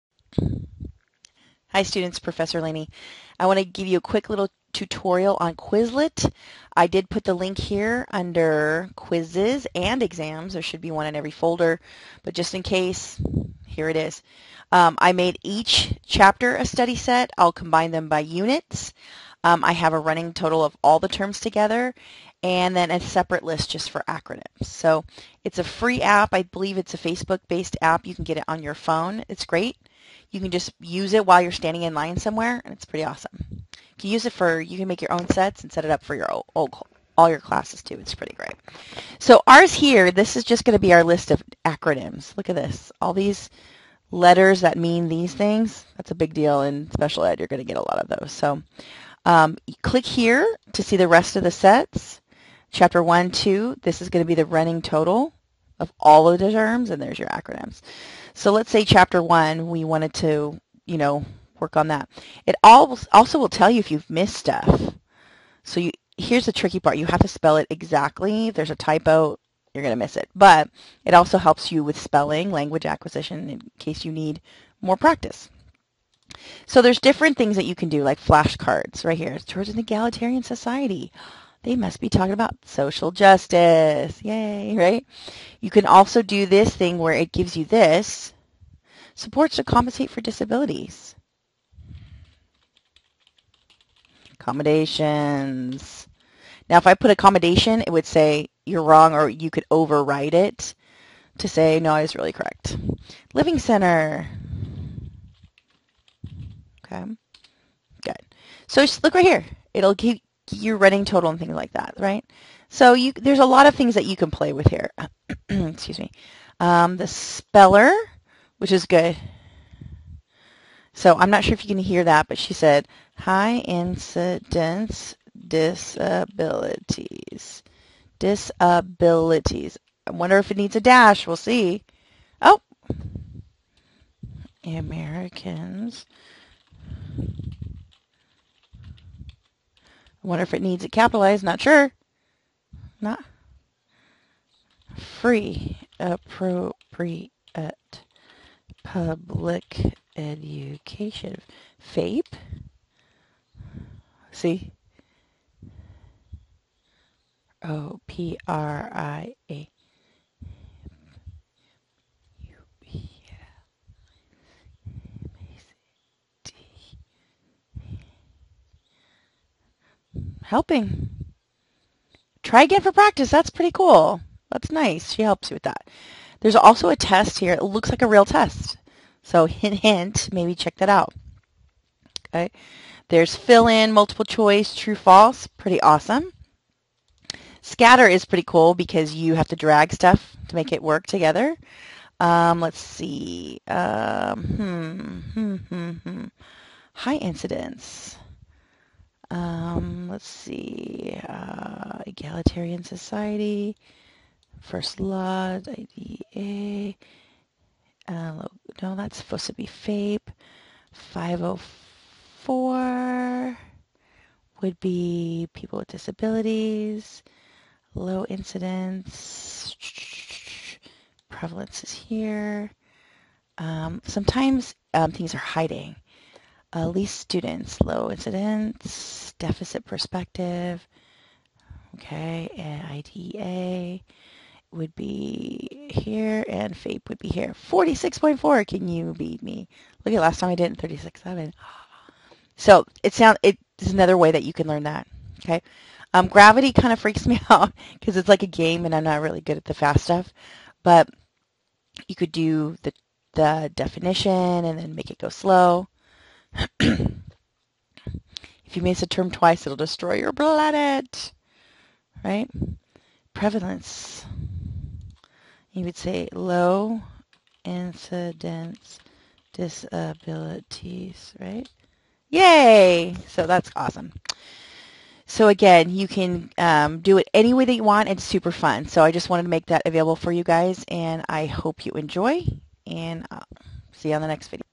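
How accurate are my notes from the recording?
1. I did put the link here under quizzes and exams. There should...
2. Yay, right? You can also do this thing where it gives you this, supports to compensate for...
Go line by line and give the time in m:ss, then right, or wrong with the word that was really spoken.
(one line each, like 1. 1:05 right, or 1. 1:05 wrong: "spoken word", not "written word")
1. 0:06 right
2. 1:24 right.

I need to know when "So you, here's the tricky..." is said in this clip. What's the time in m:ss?
1:05.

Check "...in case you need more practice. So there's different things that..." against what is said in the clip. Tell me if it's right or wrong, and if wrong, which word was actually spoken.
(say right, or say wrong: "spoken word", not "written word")
right.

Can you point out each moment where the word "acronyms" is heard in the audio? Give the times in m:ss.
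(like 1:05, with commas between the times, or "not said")
0:24, 0:41, 0:57.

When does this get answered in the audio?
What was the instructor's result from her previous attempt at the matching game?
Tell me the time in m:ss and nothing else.
4:00.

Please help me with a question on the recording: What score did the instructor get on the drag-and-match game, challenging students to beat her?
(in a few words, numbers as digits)
46.4.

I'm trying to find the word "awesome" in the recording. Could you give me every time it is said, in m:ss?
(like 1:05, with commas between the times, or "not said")
0:33, 3:05, 4:33.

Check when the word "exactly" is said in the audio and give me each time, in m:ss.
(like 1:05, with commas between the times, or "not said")
1:07.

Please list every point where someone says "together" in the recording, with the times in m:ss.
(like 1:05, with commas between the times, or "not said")
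0:21, 3:11.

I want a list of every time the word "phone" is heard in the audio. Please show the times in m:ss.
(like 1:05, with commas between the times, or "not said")
0:28.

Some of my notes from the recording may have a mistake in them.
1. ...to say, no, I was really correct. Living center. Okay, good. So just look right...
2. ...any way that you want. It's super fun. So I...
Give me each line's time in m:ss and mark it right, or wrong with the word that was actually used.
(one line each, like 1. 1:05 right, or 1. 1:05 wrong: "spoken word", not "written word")
1. 1:41 right
2. 4:37 right.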